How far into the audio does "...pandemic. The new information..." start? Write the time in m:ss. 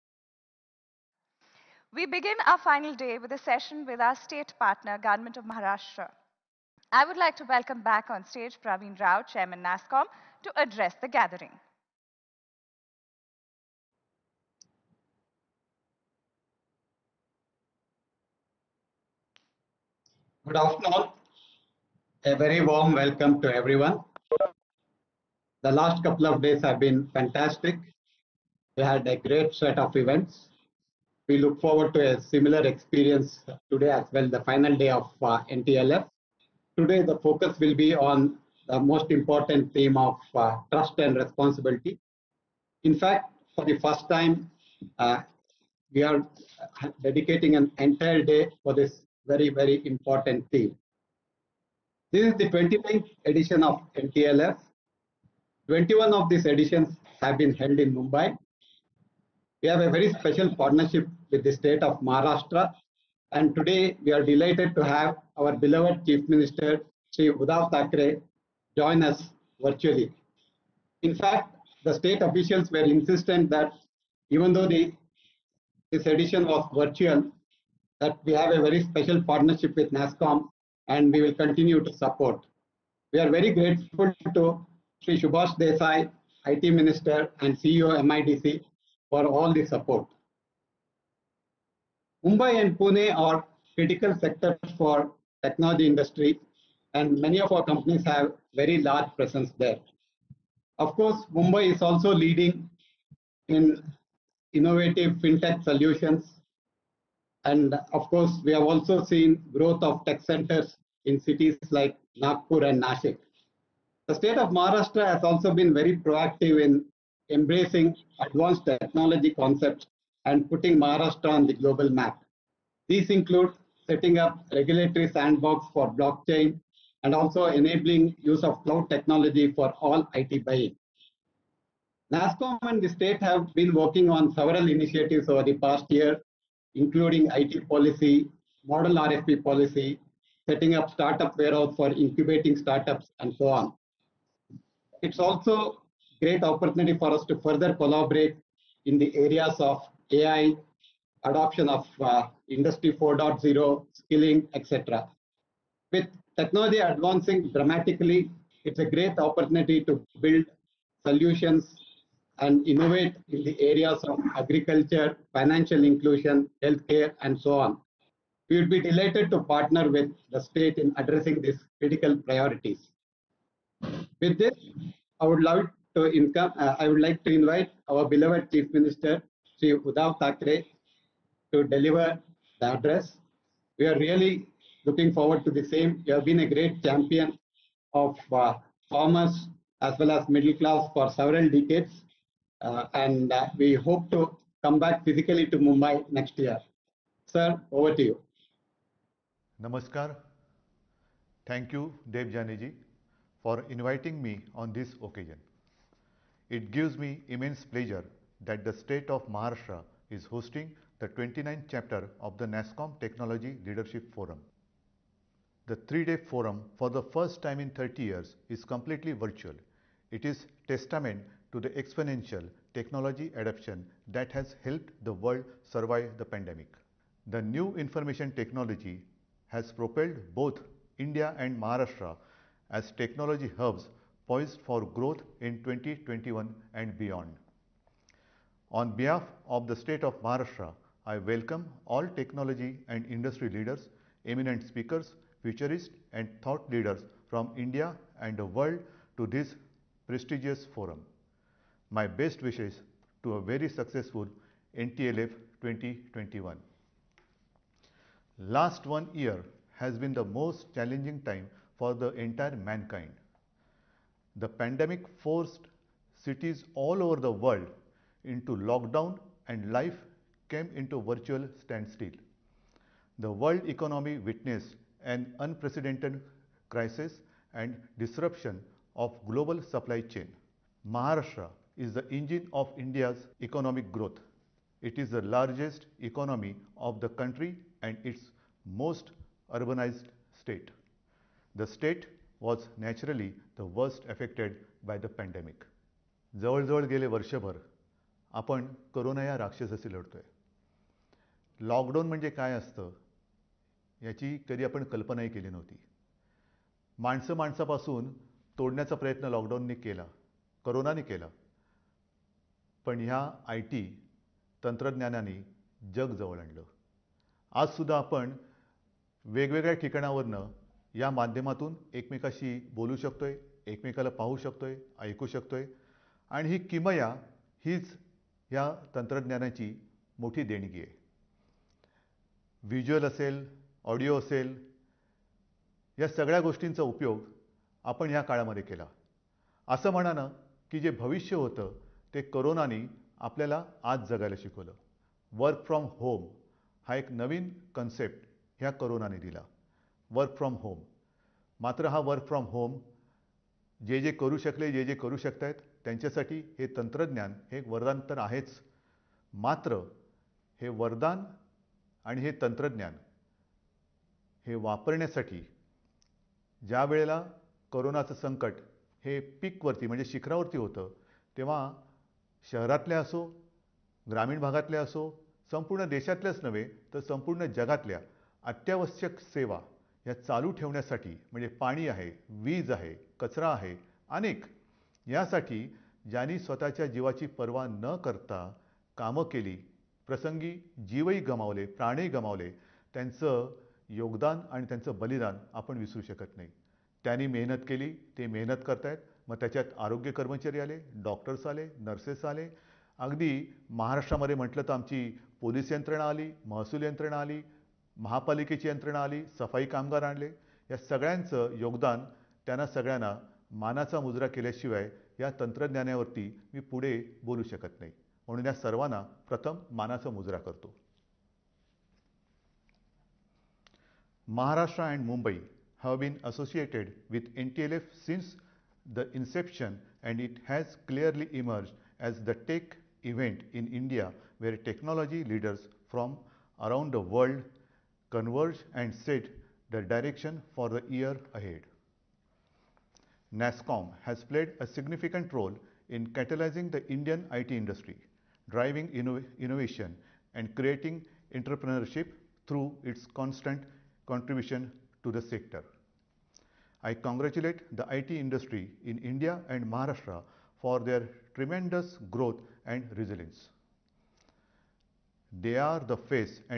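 3:46.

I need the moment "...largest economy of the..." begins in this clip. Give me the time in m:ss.
4:45.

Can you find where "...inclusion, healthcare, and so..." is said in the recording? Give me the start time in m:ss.
2:45.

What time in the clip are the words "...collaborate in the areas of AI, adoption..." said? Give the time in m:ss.
2:27.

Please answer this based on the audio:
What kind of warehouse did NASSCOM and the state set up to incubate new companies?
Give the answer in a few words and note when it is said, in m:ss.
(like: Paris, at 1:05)
Startup warehouse, at 2:20.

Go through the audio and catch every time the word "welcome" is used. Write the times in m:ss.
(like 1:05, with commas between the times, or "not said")
0:07, 0:22, 4:01.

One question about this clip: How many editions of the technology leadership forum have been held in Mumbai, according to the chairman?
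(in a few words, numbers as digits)
21.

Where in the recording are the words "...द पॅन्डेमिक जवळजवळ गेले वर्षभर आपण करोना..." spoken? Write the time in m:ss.
4:54.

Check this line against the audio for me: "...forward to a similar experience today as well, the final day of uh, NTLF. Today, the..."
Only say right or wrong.
right.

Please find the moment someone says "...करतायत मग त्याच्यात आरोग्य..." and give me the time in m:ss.
6:38.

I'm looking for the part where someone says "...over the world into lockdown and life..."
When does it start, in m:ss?
4:27.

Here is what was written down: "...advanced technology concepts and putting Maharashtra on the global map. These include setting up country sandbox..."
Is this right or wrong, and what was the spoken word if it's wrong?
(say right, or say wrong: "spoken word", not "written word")
wrong: "regulatory", not "country".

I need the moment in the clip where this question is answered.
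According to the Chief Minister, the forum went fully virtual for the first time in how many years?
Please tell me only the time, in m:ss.
3:37.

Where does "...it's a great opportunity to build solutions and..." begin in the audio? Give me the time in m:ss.
2:38.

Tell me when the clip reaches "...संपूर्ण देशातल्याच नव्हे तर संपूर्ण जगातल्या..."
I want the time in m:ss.
6:15.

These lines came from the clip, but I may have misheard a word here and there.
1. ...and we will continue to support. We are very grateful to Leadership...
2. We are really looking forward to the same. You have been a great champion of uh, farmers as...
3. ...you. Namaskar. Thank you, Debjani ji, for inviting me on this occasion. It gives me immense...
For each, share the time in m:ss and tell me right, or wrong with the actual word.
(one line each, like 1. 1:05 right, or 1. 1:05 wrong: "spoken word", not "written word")
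1. 1:20 wrong: "Sri", not "Leadership"
2. 3:03 right
3. 3:18 right.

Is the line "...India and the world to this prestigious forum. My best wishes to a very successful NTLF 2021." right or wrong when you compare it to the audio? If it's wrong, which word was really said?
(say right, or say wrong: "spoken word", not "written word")
right.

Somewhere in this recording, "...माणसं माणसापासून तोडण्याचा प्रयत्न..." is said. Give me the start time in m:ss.
5:07.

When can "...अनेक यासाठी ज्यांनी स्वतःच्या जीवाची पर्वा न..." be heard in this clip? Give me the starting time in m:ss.
6:24.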